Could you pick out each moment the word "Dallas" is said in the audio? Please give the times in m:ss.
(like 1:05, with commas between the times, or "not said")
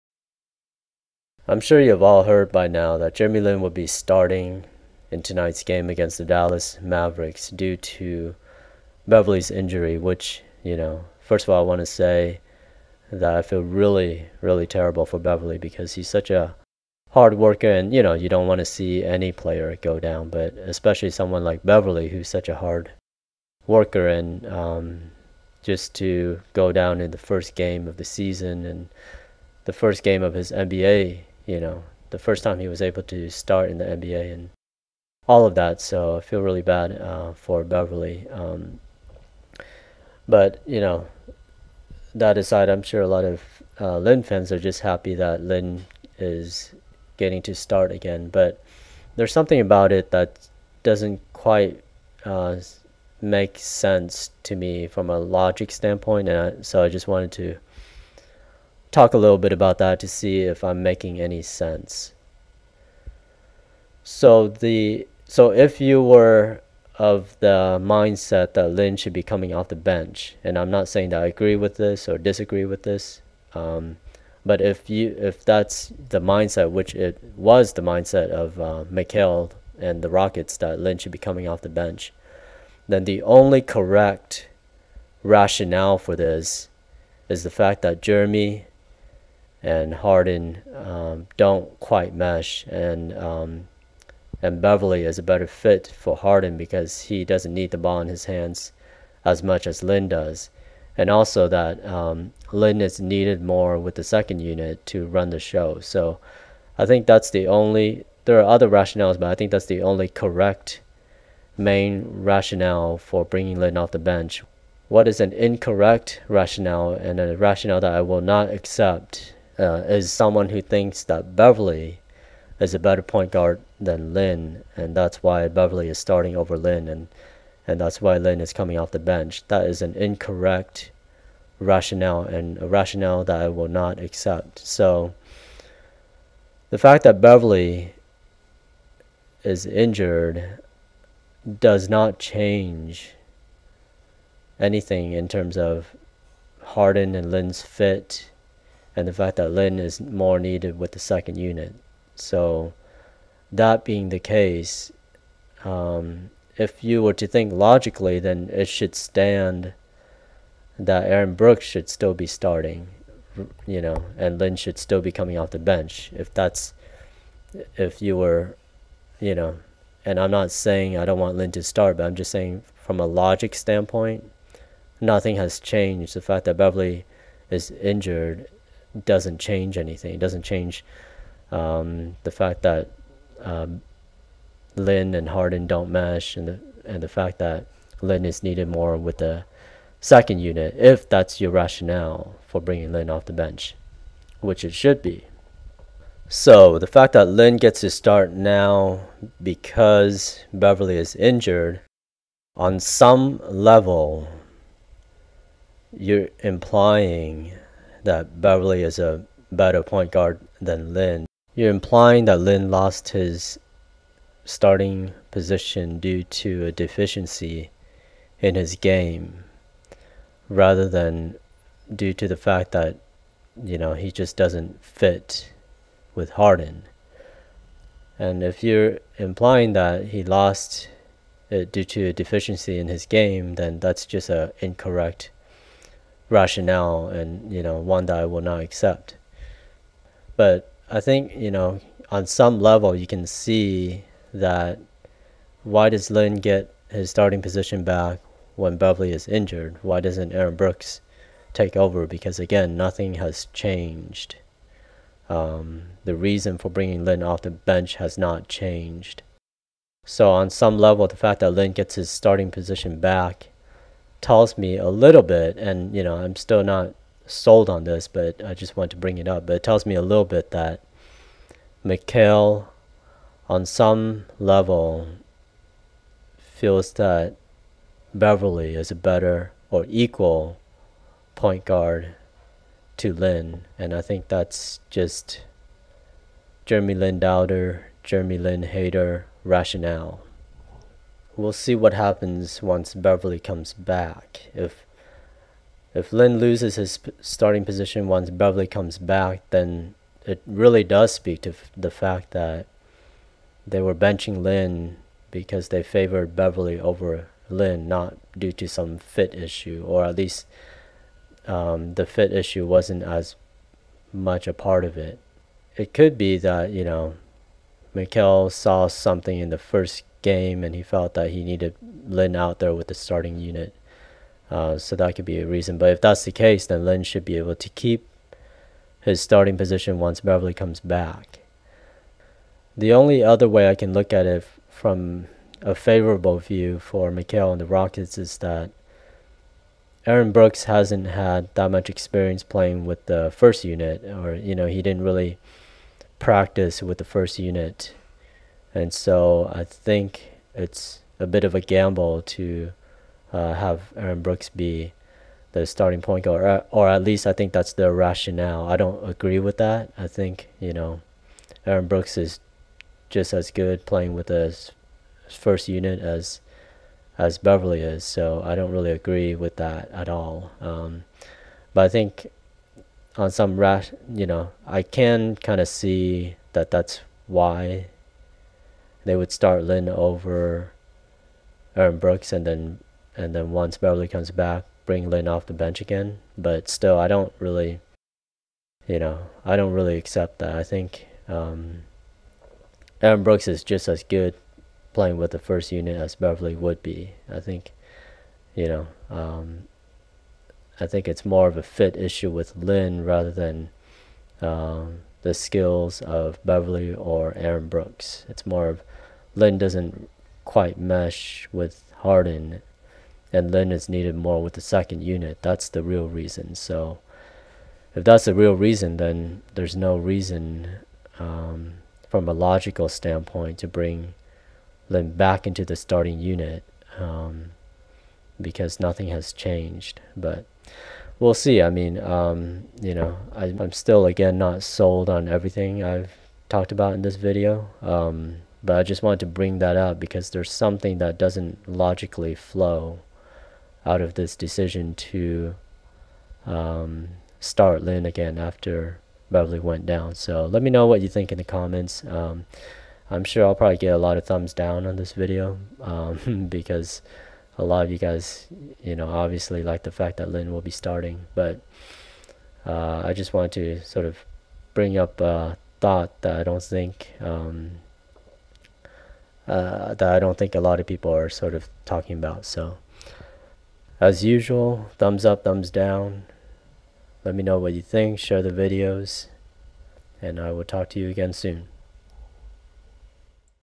0:06.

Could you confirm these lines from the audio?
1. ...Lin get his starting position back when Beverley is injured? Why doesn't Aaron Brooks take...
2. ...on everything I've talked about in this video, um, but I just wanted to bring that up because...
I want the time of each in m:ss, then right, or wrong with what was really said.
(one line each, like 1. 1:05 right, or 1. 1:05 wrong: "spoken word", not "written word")
1. 4:06 right
2. 7:15 right.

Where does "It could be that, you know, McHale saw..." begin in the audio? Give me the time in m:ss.
5:15.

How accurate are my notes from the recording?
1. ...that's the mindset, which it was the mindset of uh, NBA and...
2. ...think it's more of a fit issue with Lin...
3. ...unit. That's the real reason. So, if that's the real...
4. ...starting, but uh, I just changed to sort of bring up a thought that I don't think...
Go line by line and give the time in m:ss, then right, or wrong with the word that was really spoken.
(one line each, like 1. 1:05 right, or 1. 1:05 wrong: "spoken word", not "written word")
1. 1:15 wrong: "McHale", not "NBA"
2. 6:40 right
3. 6:55 right
4. 7:40 wrong: "wanted", not "changed".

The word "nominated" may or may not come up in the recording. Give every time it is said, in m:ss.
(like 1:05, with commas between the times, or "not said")
not said.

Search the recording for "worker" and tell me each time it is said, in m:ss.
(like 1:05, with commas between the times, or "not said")
0:17, 0:23.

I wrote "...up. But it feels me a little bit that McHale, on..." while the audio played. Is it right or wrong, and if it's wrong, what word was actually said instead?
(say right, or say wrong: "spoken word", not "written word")
wrong: "tells", not "feels".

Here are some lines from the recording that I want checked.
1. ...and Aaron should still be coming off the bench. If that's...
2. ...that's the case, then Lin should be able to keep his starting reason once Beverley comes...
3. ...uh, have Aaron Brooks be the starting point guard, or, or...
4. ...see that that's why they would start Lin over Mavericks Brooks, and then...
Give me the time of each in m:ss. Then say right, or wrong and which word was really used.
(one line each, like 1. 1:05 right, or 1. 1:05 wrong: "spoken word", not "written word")
1. 2:44 wrong: "Lin", not "Aaron"
2. 5:26 wrong: "position", not "reason"
3. 5:53 right
4. 6:15 wrong: "Aaron", not "Mavericks".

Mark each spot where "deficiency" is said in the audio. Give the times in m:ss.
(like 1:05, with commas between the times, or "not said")
3:36, 3:52.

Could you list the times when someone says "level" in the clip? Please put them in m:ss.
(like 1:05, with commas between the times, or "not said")
3:23, 4:02, 4:20, 4:34.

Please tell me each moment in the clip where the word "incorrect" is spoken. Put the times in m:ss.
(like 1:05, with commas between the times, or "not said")
1:55, 2:09, 3:54.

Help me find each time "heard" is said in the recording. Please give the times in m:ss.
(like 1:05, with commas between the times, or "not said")
0:02.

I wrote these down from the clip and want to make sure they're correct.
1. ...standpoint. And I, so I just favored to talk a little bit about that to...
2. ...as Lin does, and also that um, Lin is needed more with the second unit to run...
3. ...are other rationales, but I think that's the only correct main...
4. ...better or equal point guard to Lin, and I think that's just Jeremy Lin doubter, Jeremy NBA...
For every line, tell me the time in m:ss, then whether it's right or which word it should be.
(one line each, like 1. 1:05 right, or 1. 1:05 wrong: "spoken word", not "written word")
1. 0:55 wrong: "wanted", not "favored"
2. 1:39 right
3. 1:48 right
4. 4:38 wrong: "Lin", not "NBA".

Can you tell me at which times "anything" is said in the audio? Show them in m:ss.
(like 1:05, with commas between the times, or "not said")
2:24, 2:59.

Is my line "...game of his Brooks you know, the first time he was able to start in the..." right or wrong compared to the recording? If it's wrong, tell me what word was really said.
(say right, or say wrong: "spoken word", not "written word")
wrong: "NBA", not "Brooks".